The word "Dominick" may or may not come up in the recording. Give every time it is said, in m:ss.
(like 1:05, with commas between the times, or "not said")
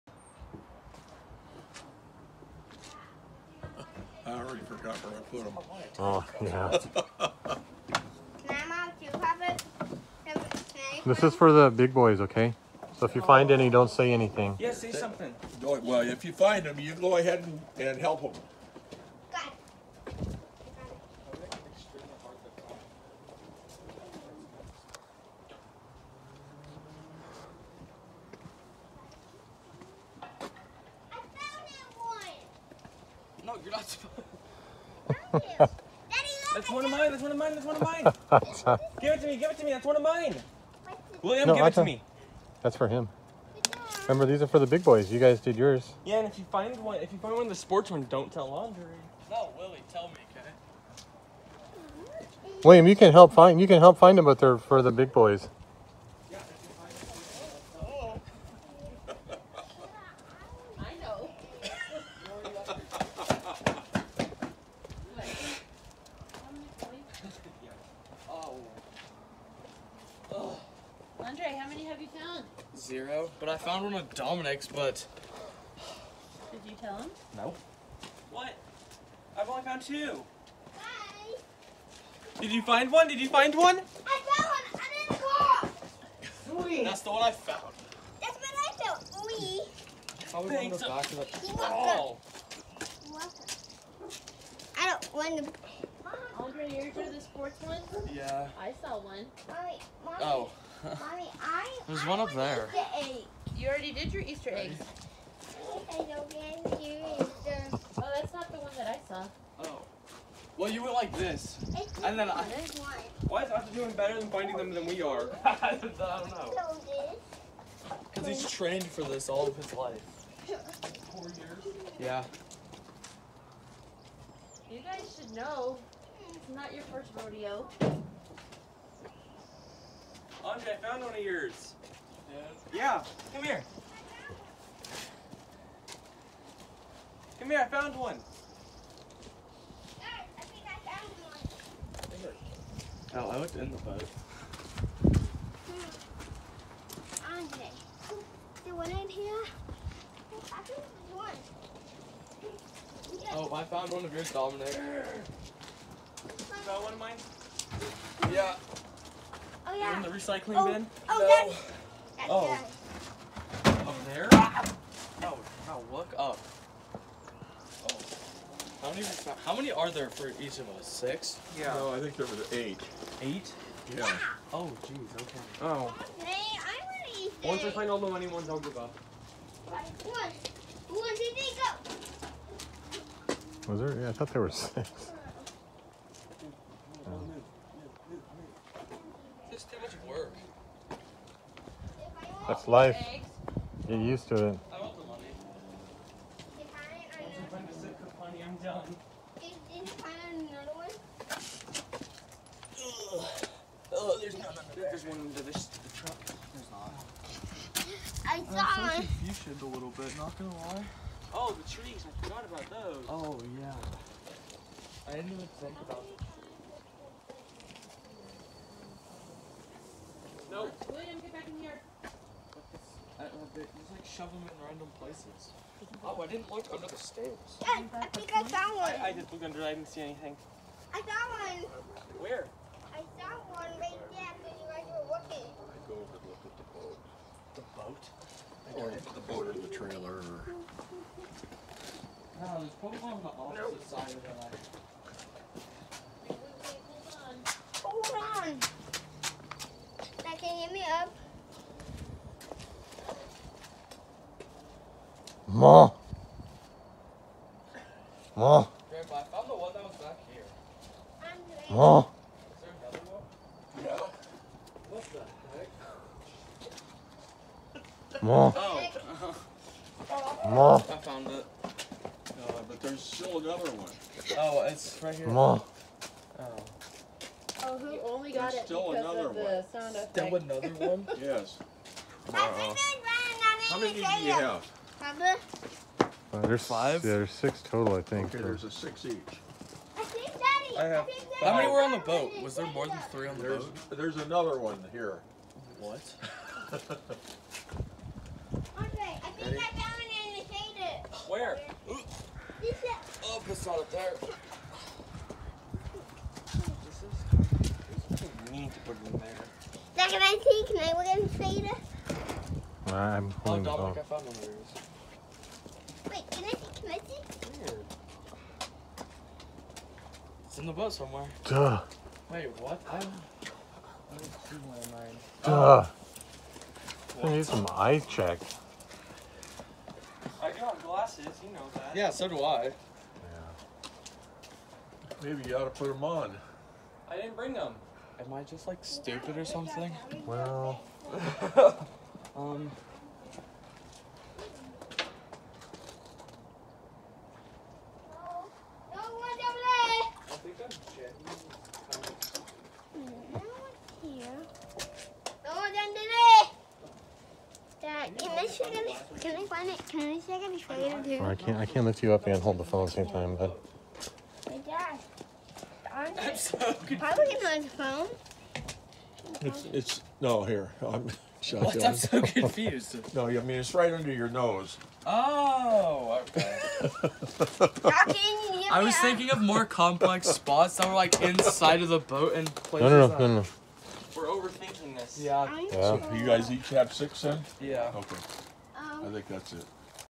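1:14, 2:34, 5:13.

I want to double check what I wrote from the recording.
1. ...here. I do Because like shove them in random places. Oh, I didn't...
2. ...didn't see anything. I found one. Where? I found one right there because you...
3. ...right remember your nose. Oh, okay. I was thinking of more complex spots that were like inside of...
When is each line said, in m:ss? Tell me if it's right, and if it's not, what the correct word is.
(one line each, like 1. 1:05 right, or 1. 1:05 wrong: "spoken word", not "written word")
1. 3:41 wrong: "Just", not "Because"
2. 3:49 right
3. 6:13 wrong: "under", not "remember".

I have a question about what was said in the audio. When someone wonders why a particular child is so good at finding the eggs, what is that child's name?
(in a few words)
Arthur.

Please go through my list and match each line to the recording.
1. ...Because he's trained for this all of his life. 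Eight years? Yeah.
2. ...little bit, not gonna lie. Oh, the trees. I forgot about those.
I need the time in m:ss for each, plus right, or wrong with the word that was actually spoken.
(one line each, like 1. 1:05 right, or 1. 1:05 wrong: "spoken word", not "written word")
1. 1:58 wrong: "Four", not "Eight"
2. 3:29 right.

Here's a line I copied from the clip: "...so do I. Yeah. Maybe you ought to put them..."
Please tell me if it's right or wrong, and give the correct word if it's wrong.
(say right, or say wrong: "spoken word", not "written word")
right.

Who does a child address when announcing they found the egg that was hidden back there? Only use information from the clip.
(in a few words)
Grandpa.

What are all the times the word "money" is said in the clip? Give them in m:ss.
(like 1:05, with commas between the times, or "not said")
2:58.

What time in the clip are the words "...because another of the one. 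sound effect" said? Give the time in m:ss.
4:38.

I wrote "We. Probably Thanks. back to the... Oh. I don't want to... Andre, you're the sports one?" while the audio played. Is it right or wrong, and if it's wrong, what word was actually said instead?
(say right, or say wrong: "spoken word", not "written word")
right.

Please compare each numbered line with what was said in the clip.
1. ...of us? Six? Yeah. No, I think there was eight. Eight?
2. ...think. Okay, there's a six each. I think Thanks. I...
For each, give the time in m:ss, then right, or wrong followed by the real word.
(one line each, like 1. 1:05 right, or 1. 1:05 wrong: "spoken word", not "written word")
1. 2:50 right
2. 4:48 wrong: "Daddy", not "Thanks".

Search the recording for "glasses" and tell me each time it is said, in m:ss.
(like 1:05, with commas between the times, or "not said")
5:30.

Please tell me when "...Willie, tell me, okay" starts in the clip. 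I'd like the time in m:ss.
0:49.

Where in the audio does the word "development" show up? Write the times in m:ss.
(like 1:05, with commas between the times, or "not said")
not said.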